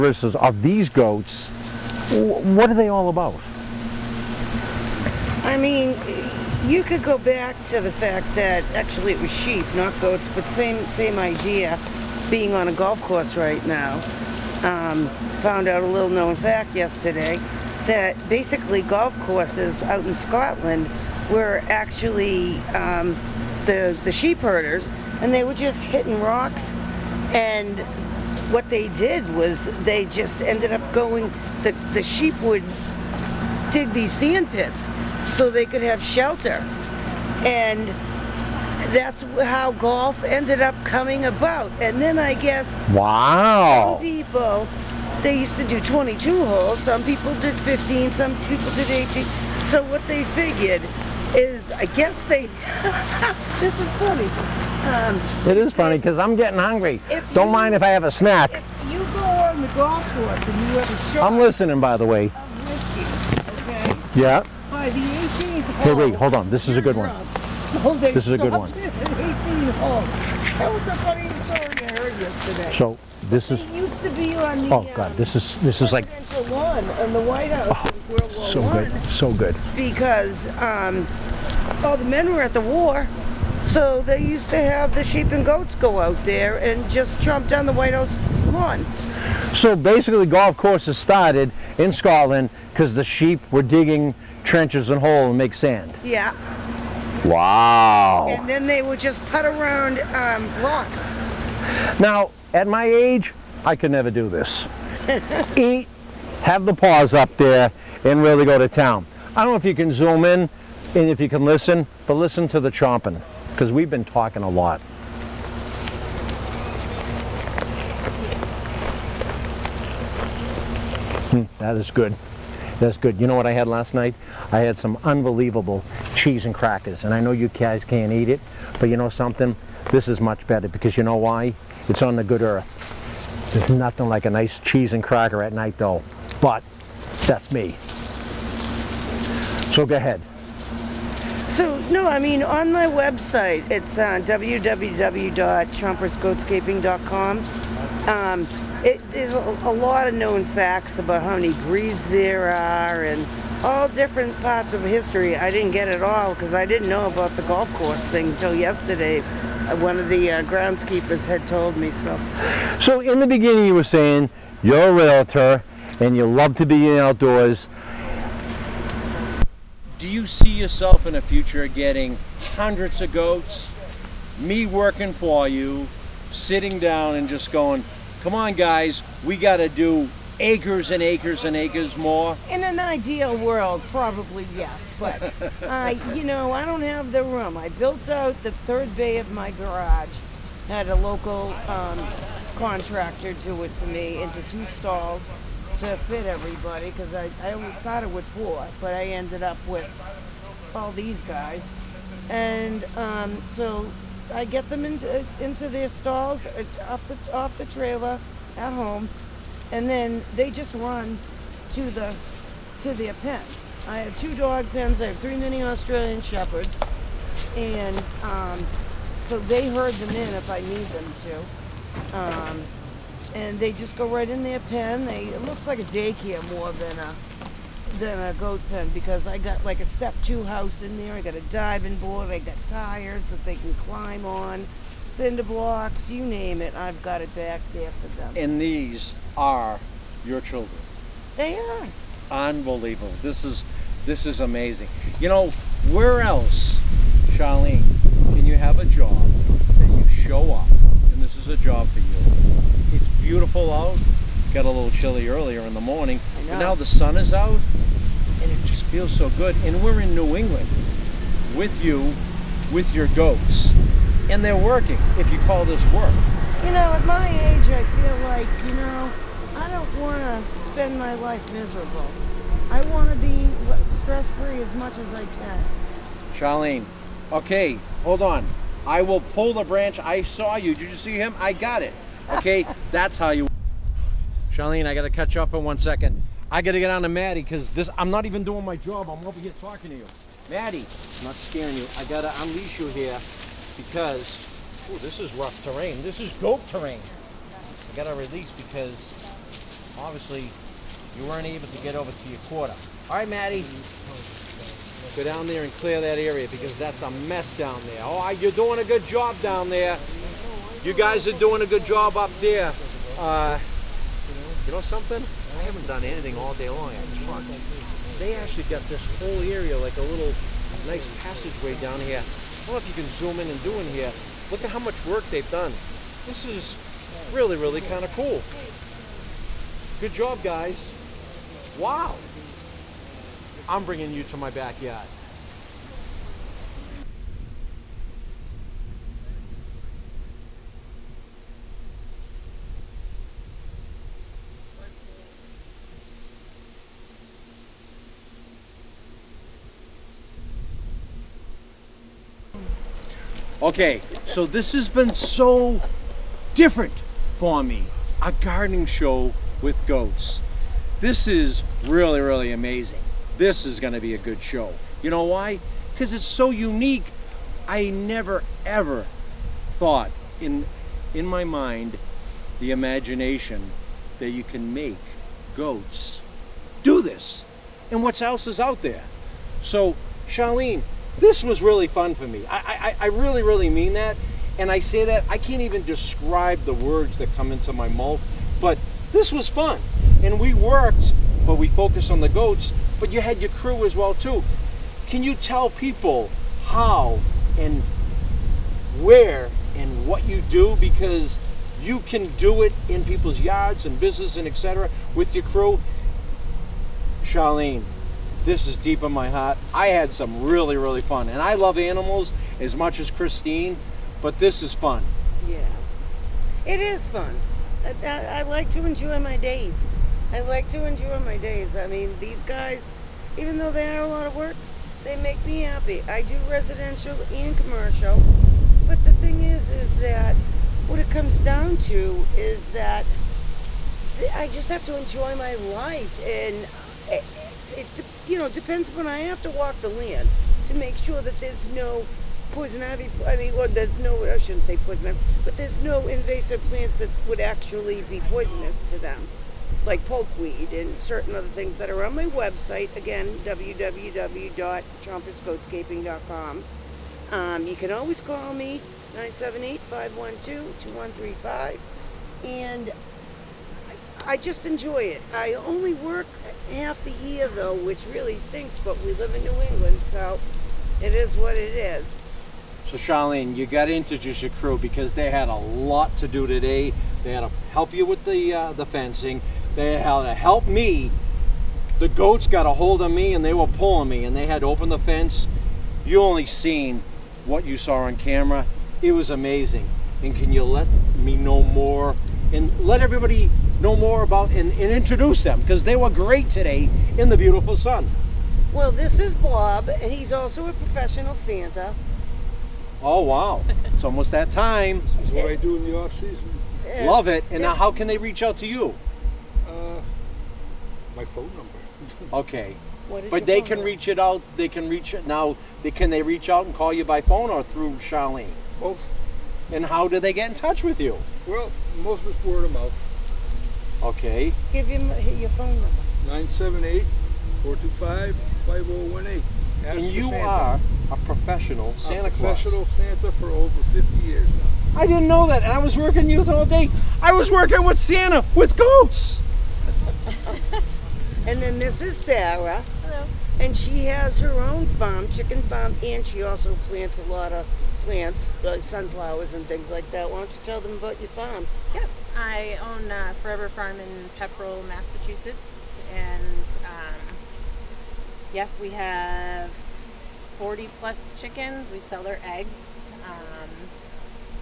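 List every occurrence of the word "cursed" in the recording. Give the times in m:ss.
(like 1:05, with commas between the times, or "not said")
not said.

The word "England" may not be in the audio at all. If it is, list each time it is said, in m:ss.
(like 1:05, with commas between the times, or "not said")
4:20, 7:49.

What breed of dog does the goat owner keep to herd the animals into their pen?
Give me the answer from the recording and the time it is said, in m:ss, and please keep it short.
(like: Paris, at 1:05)
Mini Australian Shepherds, at 3:35.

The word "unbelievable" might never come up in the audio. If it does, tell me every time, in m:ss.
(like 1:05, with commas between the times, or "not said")
2:05, 4:02.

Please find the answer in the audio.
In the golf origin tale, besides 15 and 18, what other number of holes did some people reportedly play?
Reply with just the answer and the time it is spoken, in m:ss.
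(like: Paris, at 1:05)
22, at 0:45.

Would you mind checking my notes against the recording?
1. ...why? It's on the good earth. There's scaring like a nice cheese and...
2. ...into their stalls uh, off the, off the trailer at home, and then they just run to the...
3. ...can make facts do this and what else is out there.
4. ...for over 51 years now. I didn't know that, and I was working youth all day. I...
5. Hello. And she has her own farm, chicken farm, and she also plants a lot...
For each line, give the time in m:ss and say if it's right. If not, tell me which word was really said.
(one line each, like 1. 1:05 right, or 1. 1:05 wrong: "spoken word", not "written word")
1. 2:11 wrong: "nothing", not "scaring"
2. 3:25 right
3. 6:14 wrong: "goats", not "facts"
4. 8:53 wrong: "50", not "51"
5. 9:03 right.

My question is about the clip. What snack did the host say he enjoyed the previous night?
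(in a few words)
Cheese and crackers.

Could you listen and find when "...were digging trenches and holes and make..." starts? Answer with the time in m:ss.
1:33.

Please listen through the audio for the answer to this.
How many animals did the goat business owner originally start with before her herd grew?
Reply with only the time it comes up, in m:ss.
3:18.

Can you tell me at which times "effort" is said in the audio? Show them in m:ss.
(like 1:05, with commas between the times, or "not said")
not said.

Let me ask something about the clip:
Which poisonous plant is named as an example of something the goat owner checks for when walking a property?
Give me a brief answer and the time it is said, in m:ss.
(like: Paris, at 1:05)
Pokeweed, at 7:30.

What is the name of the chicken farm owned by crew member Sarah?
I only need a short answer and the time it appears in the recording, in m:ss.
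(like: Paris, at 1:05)
Forever Farm, at 9:13.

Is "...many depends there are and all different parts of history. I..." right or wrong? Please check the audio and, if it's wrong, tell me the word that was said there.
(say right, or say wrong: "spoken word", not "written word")
wrong: "breeds", not "depends".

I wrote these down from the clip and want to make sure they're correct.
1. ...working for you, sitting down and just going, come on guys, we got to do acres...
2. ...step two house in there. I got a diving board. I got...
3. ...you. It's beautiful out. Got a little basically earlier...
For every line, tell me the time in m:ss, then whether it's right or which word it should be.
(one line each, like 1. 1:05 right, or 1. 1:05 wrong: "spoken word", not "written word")
1. 2:54 right
2. 3:49 right
3. 4:12 wrong: "chilly", not "basically".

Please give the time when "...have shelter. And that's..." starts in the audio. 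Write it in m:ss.
0:35.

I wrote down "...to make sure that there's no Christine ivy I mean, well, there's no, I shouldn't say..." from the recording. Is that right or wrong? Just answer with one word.
wrong.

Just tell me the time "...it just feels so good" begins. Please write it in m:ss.
4:18.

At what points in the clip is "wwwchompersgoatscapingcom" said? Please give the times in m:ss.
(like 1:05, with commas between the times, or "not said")
2:24, 7:33.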